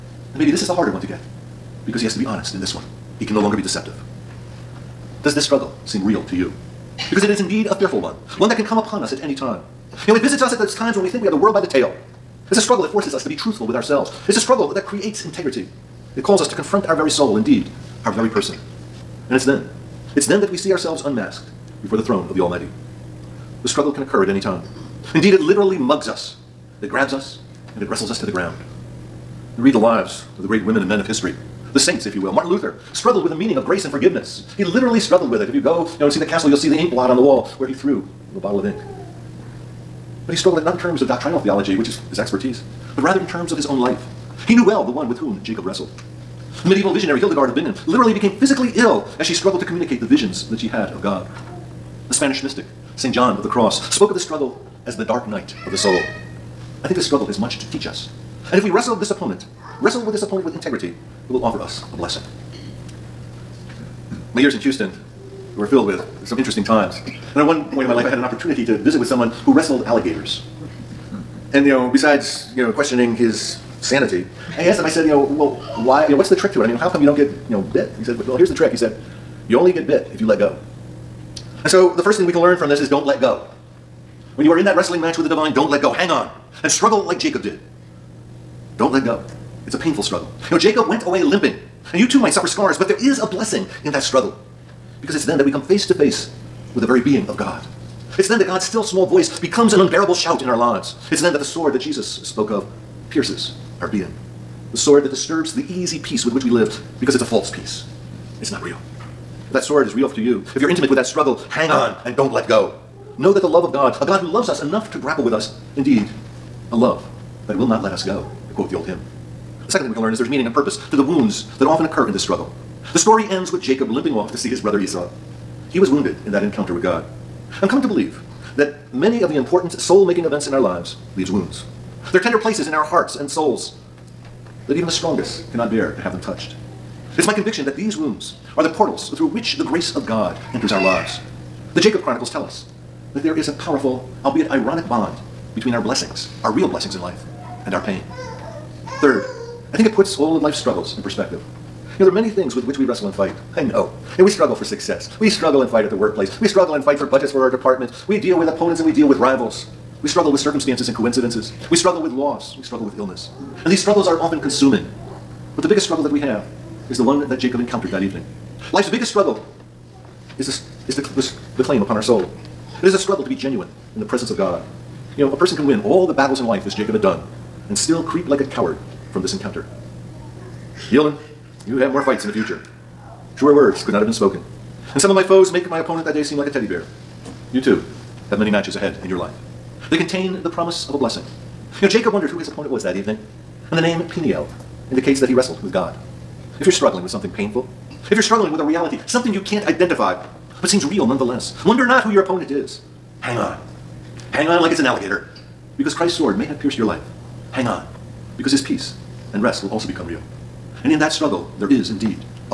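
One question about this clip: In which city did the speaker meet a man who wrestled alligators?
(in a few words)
Houston.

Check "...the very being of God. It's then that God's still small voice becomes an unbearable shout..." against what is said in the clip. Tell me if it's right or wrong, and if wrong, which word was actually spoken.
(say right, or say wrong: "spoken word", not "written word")
right.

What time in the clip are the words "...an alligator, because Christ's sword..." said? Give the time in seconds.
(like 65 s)
204 s.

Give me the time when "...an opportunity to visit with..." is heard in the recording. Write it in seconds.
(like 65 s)
68 s.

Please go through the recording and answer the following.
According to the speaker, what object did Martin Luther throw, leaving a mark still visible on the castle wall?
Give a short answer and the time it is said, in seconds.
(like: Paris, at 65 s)
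A bottle of ink, at 38 s.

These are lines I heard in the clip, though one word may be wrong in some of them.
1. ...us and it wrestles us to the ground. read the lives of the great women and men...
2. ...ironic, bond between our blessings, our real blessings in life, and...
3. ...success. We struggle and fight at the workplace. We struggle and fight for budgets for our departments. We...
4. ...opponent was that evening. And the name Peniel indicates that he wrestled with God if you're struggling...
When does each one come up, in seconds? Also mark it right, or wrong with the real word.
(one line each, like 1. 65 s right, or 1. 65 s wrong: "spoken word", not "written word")
1. 27 s right
2. 144 s right
3. 154 s right
4. 192 s right.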